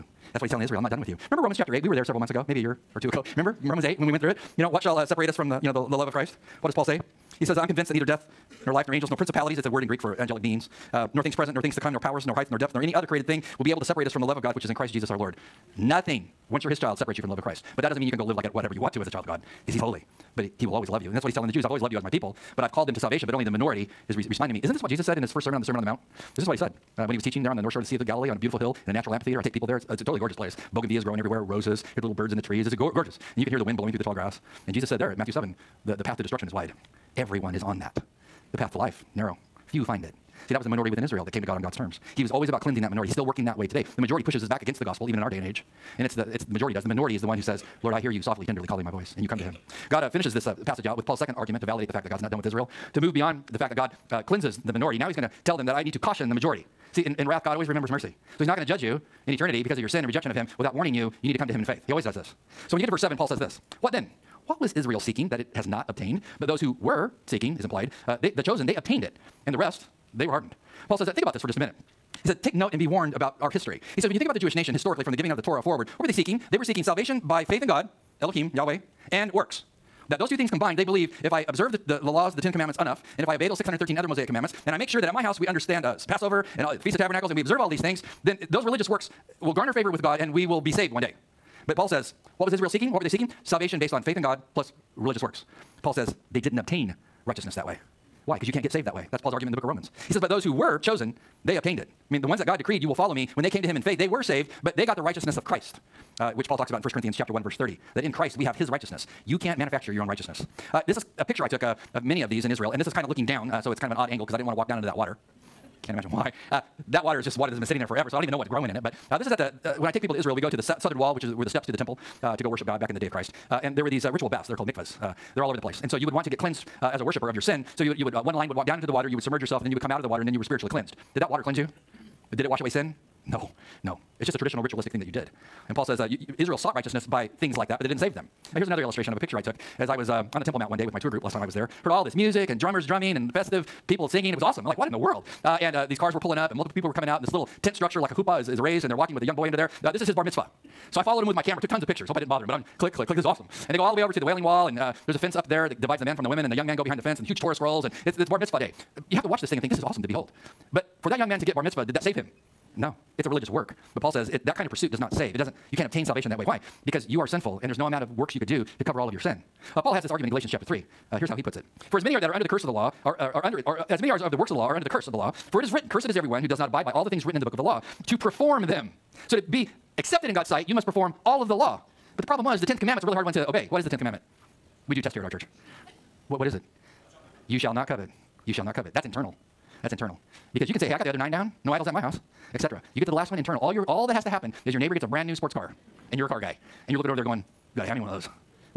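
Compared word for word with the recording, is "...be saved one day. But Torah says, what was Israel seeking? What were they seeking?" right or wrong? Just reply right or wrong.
wrong.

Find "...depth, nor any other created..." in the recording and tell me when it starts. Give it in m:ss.
0:12.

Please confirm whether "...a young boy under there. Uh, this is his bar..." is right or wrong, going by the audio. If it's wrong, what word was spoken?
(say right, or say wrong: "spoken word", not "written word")
right.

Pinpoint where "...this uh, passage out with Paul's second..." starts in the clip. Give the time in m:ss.
0:50.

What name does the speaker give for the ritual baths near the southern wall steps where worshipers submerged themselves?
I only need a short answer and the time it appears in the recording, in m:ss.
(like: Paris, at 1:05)
mikvahs, at 2:04.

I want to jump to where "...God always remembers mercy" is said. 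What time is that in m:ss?
0:57.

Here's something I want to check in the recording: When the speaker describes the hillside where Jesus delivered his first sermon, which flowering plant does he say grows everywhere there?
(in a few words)
Bougainvillea.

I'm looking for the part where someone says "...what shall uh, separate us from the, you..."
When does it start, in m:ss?
0:04.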